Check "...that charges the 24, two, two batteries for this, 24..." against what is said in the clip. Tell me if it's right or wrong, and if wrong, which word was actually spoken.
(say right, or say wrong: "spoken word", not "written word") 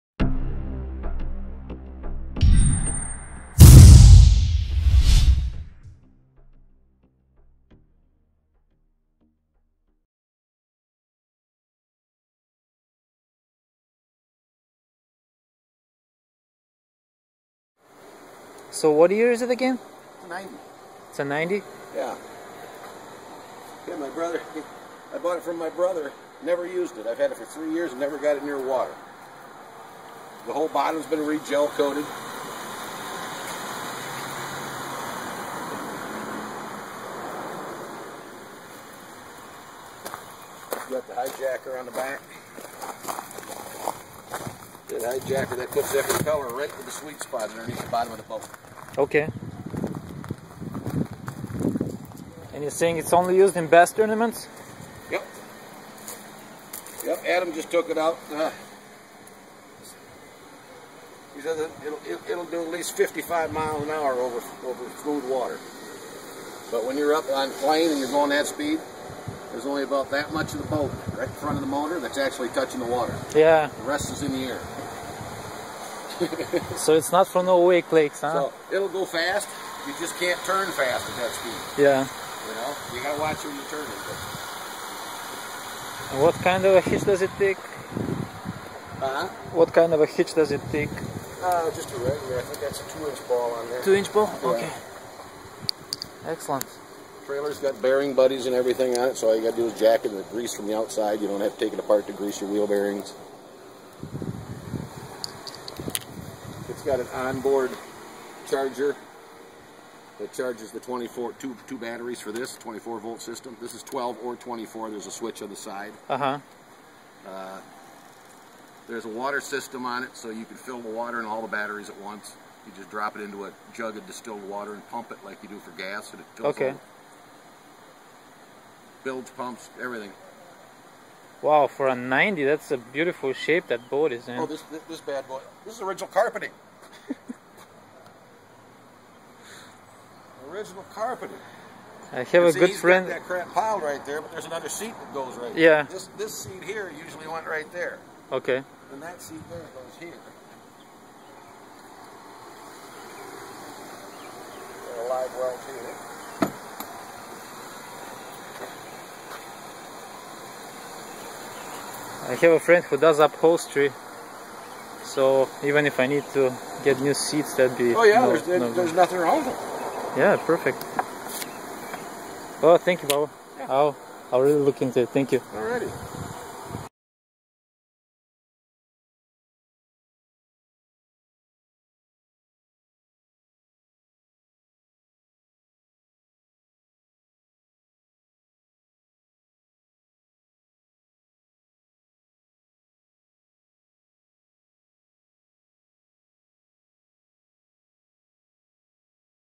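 right.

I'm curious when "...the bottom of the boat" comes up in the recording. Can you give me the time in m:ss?
0:47.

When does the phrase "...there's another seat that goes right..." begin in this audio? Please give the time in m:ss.
2:24.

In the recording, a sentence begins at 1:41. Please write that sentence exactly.
You don't have to take it apart to grease your wheel bearings.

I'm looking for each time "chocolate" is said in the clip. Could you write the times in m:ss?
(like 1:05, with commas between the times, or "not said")
not said.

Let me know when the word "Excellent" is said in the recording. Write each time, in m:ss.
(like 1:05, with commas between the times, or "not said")
1:36.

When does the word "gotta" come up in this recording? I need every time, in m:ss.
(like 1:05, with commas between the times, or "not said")
1:23, 1:39.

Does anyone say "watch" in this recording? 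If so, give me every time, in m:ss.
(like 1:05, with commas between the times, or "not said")
1:23.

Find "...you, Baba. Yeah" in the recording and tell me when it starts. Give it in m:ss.
2:53.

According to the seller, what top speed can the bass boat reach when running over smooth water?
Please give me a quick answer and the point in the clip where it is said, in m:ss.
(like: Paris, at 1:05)
55 miles an hour, at 1:02.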